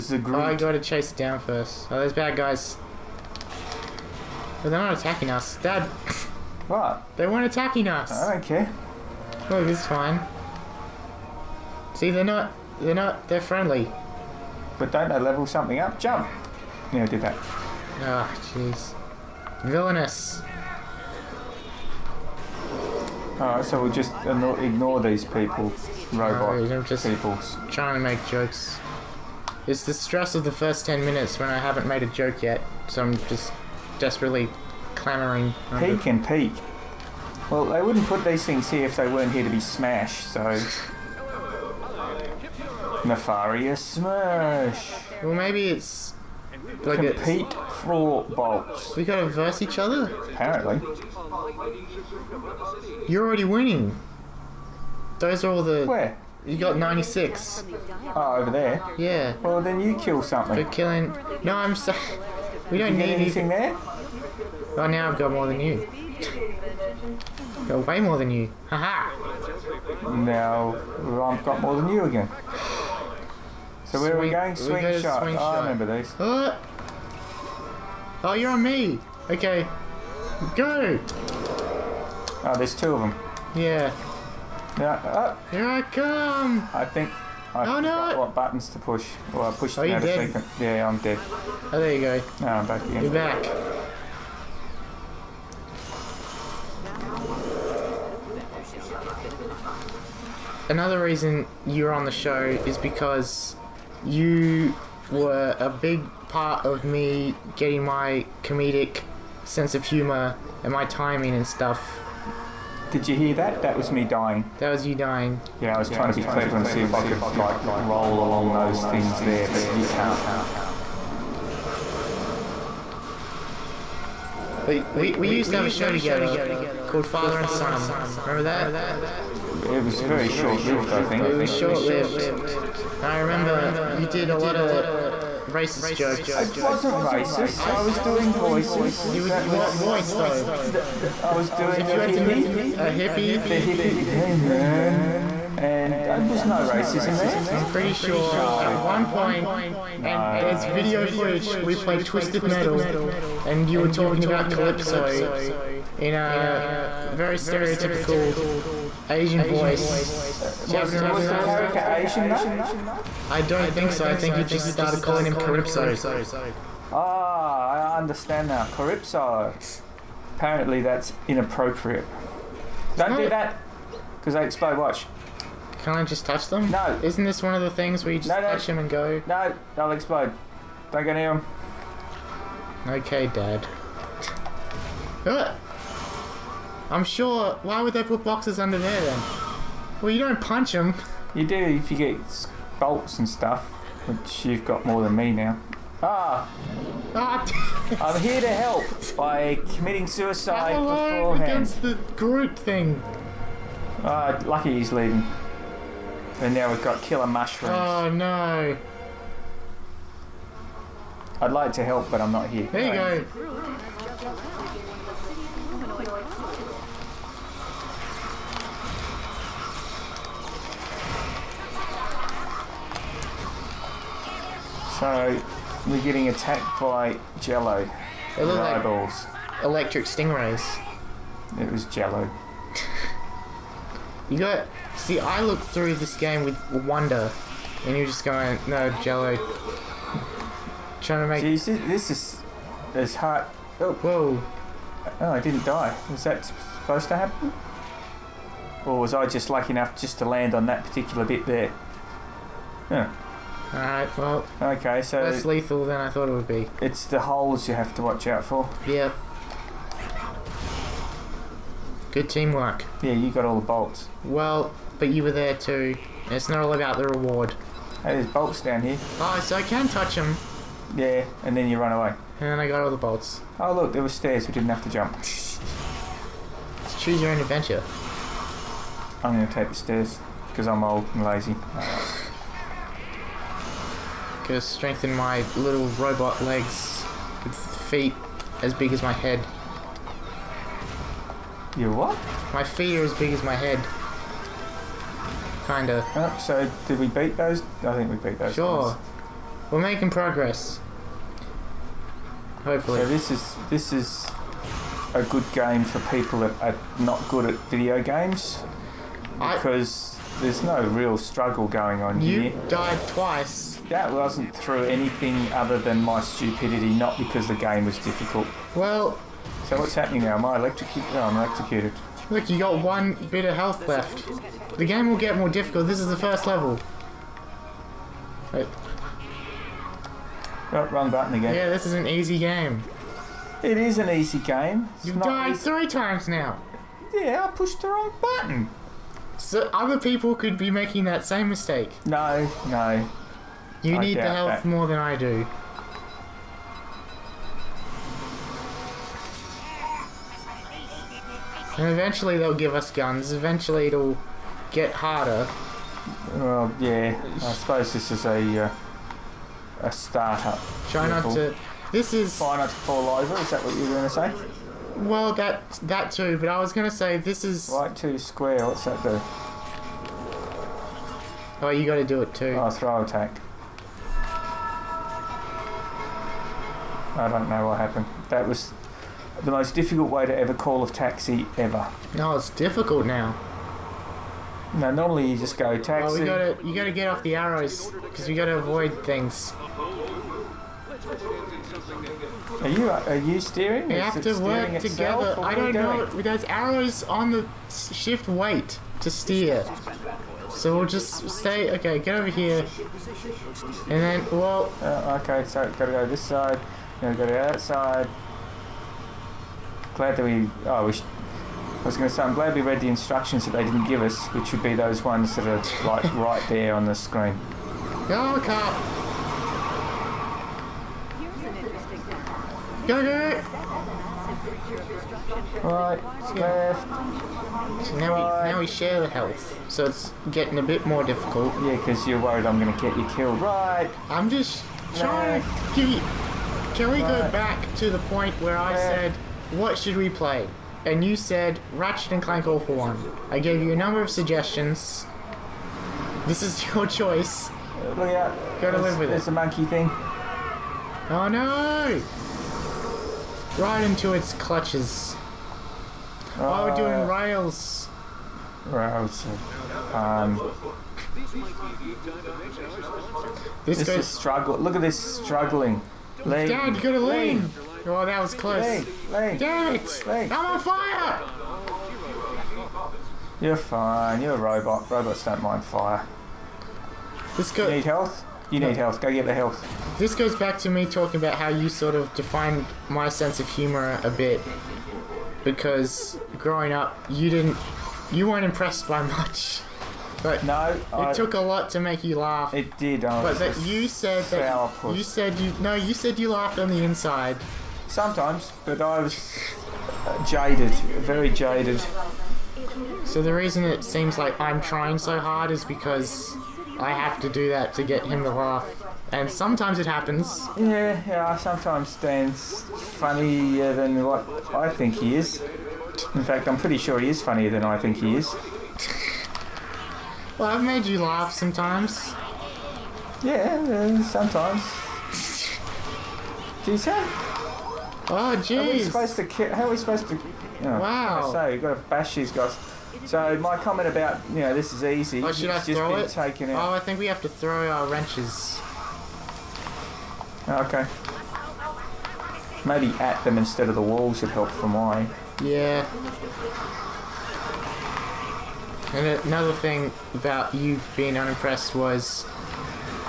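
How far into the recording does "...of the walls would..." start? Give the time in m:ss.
9:03.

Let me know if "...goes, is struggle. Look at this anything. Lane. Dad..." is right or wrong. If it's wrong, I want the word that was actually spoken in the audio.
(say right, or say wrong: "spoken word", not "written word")
wrong: "struggling", not "anything".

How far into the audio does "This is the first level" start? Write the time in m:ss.
5:25.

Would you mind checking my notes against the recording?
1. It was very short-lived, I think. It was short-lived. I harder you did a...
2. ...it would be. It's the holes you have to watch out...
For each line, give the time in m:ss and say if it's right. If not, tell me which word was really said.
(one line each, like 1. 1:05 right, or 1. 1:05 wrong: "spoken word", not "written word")
1. 2:09 wrong: "remember", not "harder"
2. 4:16 right.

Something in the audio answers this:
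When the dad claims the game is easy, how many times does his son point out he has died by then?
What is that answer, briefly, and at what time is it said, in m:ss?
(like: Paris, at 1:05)
3, at 5:35.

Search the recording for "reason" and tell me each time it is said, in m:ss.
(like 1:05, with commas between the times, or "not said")
1:41, 8:23.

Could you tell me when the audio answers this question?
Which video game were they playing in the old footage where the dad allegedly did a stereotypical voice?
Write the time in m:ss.
2:32.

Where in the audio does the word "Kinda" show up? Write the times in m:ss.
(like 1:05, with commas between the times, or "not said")
4:55.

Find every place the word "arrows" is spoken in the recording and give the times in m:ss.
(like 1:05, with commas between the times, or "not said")
6:27, 6:36.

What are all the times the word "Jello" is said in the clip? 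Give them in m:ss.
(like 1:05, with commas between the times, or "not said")
3:47, 3:51, 3:59.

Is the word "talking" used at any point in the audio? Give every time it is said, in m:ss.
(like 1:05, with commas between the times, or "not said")
2:33, 8:00.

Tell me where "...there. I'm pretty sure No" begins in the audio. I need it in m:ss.
2:27.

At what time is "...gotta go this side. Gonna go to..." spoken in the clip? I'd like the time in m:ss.
6:45.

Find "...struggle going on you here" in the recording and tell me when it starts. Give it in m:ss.
5:11.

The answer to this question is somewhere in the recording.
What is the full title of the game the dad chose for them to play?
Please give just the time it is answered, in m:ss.
7:21.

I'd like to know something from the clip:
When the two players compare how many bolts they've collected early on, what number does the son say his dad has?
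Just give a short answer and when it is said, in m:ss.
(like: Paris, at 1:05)
96, at 0:56.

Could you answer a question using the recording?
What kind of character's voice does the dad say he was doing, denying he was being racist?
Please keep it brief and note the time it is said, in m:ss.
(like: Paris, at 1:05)
A hippie, at 2:22.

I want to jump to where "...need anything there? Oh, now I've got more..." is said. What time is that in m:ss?
1:02.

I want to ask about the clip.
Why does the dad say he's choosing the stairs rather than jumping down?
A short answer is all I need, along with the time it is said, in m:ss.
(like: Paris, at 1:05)
Old and lazy, at 4:40.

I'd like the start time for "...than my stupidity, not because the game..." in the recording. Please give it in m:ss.
5:15.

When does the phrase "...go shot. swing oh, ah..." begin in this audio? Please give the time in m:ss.
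1:14.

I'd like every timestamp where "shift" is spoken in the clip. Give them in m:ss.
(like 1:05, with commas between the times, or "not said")
6:37.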